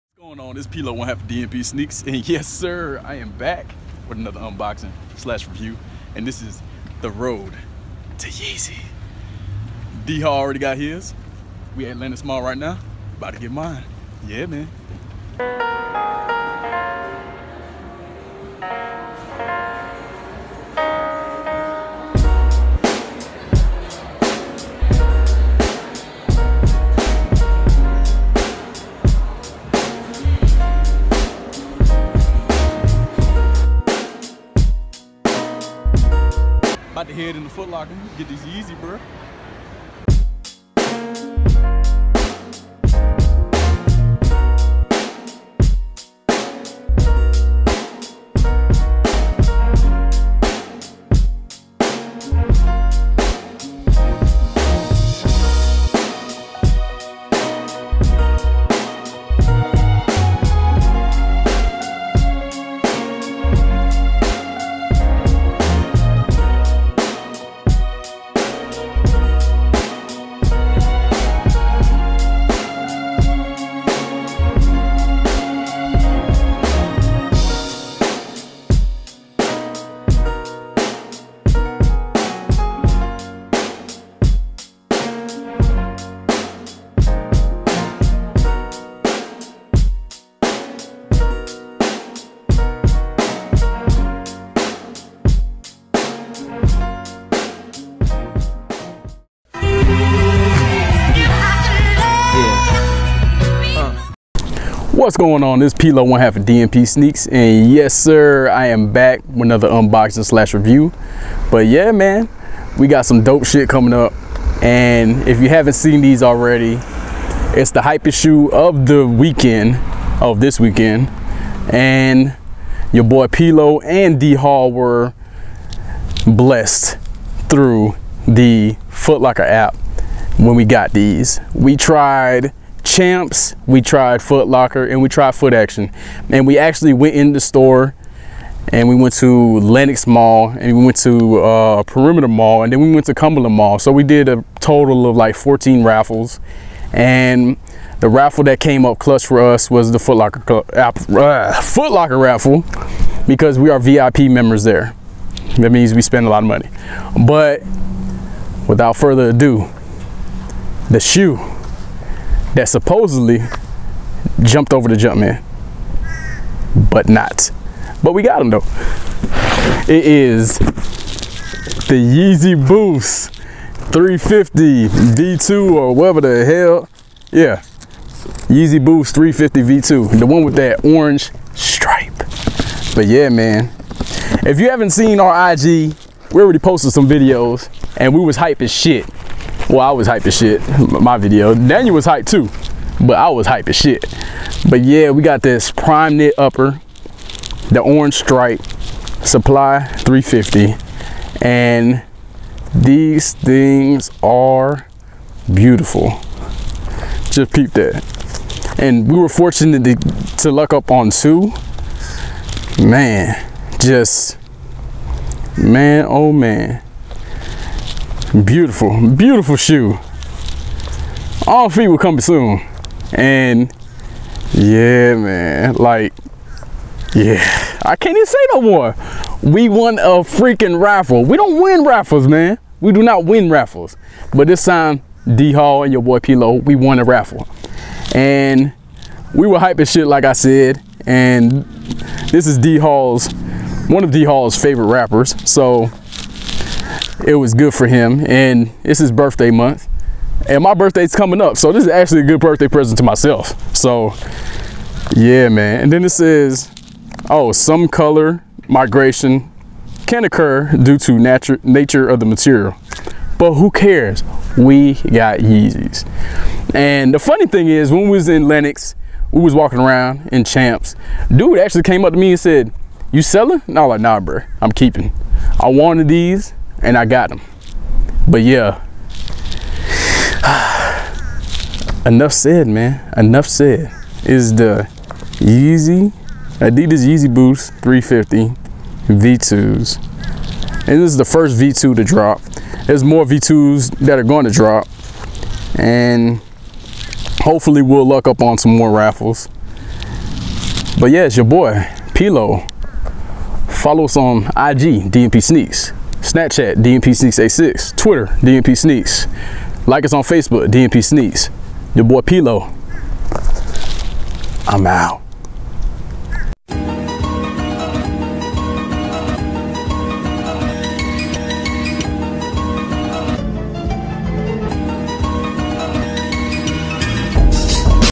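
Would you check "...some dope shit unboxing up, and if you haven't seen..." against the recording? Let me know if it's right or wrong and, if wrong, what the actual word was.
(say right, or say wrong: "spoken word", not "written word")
wrong: "coming", not "unboxing".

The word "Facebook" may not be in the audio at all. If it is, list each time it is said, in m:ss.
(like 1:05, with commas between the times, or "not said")
5:10.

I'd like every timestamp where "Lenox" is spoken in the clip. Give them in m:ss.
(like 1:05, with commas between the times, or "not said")
2:19, 4:28.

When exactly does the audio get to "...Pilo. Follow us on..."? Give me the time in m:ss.
5:02.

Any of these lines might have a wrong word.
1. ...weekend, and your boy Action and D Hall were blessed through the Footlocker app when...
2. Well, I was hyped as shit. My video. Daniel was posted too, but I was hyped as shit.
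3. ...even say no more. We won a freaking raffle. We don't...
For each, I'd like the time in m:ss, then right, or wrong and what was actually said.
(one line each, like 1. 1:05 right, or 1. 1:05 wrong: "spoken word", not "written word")
1. 2:00 wrong: "Pilo", not "Action"
2. 3:09 wrong: "hyped", not "posted"
3. 3:48 right.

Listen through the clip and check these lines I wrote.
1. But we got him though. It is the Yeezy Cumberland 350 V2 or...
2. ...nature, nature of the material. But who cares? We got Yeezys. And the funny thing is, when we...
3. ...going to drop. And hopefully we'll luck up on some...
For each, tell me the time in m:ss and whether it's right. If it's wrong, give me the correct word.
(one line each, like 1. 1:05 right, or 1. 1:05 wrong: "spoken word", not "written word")
1. 2:48 wrong: "Boost", not "Cumberland"
2. 4:21 right
3. 4:54 right.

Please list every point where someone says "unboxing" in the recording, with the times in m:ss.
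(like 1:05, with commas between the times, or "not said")
0:04, 1:49.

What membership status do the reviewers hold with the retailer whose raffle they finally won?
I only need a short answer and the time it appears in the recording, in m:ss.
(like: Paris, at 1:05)
VIP, at 2:33.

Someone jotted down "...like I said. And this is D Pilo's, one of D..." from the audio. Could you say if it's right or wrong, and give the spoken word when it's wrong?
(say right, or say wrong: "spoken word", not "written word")
wrong: "Hall", not "Pilo".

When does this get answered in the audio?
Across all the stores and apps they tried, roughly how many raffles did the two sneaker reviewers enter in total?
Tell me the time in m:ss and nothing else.
2:25.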